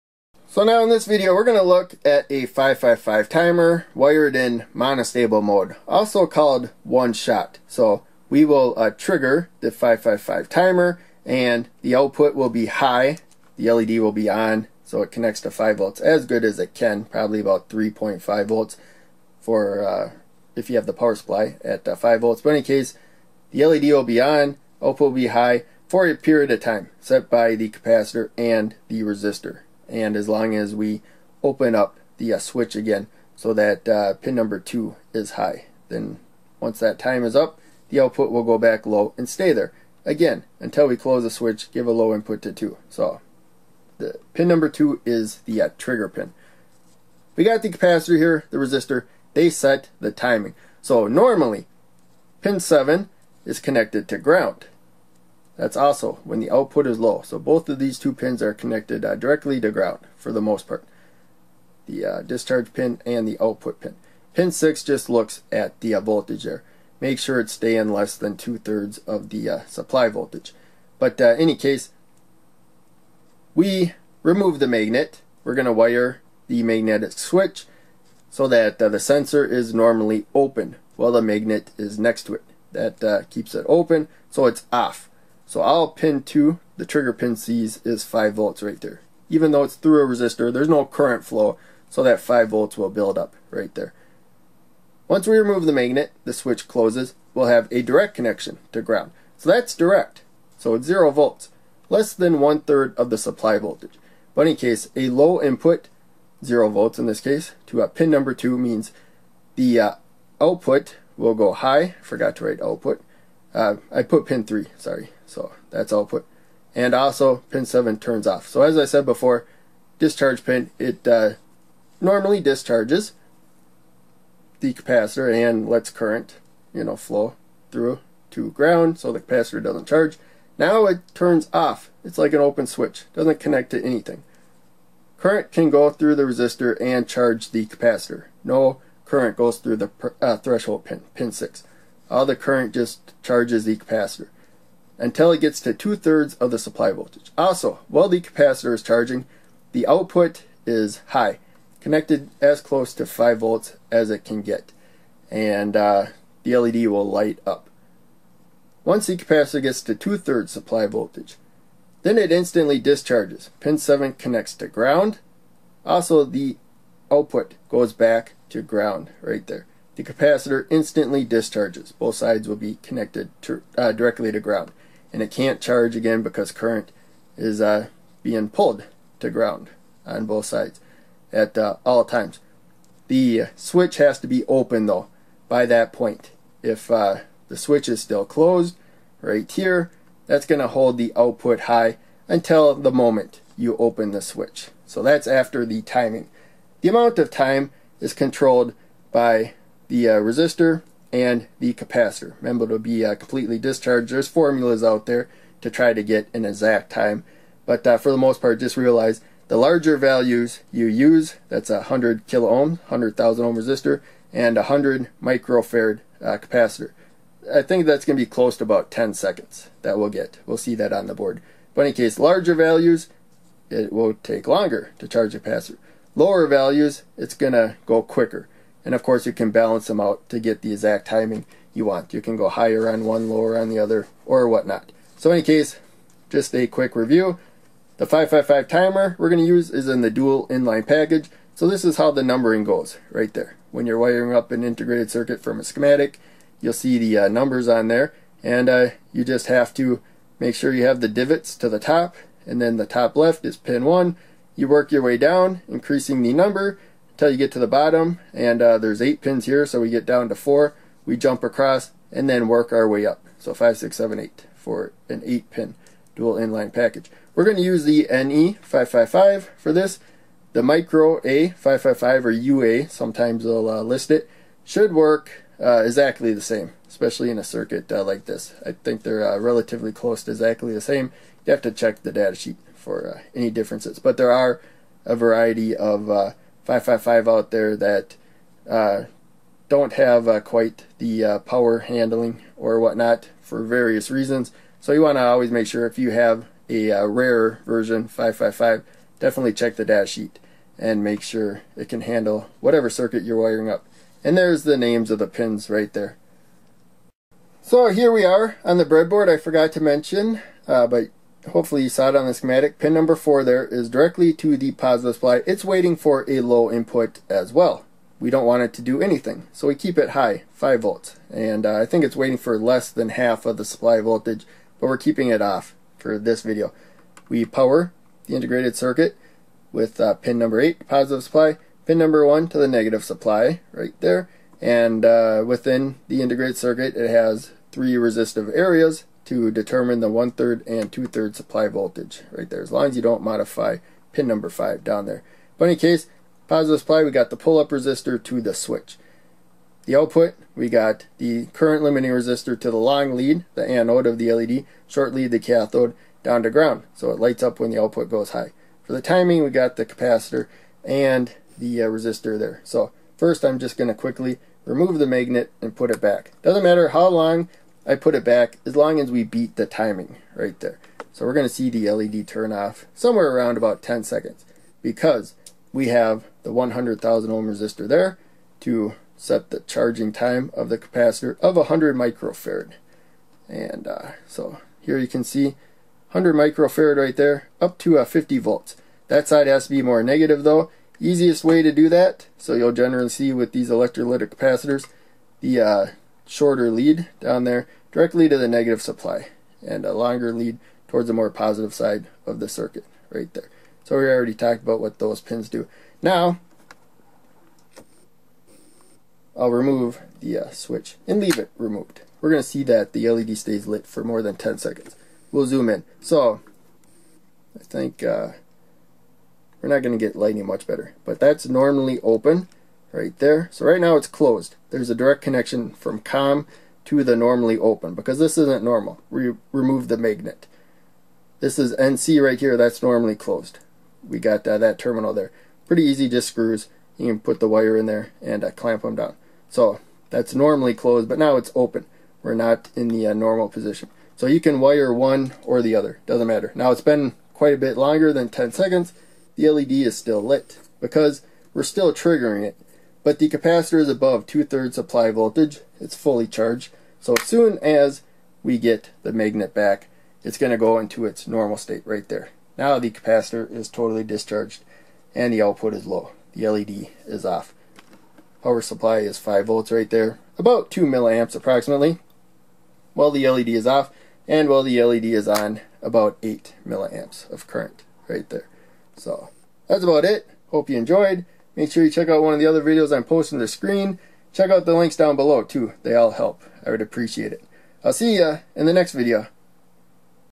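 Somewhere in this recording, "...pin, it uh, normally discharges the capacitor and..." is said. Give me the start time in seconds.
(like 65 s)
120 s.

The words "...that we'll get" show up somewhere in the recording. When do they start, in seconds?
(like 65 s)
219 s.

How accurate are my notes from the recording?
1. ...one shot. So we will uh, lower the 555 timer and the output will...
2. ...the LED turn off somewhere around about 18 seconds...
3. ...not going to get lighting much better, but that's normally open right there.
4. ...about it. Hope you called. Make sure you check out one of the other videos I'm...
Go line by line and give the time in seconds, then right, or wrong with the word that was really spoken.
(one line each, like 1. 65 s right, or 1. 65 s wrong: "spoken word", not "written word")
1. 6 s wrong: "trigger", not "lower"
2. 371 s wrong: "10", not "18"
3. 419 s right
4. 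479 s wrong: "enjoyed", not "called".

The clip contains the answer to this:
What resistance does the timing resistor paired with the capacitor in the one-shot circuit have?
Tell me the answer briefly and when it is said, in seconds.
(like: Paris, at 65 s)
100 kilo ohm, at 211 s.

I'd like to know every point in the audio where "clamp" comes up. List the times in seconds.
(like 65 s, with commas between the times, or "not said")
438 s.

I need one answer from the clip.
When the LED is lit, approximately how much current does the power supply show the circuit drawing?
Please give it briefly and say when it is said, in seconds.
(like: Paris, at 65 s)
8 milliamps, at 476 s.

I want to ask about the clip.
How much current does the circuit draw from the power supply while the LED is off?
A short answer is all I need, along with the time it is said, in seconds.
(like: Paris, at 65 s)
2 milliamps, at 470 s.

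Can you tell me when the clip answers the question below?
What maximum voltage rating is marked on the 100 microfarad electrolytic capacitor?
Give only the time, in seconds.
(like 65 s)
388 s.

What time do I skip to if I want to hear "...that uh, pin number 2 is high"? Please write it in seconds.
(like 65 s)
33 s.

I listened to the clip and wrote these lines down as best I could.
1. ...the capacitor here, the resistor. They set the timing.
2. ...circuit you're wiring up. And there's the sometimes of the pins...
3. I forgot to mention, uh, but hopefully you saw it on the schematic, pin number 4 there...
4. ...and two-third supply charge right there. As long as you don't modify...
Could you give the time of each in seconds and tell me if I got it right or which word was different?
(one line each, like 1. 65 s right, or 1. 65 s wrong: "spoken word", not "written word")
1. 47 s right
2. 302 s wrong: "names", not "sometimes"
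3. 309 s right
4. 340 s wrong: "voltage", not "charge".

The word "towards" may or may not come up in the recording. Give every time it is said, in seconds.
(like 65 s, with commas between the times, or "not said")
400 s.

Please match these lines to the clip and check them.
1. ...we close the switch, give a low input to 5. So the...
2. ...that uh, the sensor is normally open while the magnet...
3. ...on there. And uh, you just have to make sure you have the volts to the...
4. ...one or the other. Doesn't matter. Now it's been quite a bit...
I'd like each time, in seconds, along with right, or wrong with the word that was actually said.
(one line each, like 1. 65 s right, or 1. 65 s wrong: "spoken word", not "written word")
1. 40 s wrong: "2", not "5"
2. 78 s right
3. 247 s wrong: "divots", not "volts"
4. 444 s right.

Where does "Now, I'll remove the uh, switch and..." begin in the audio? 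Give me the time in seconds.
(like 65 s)
406 s.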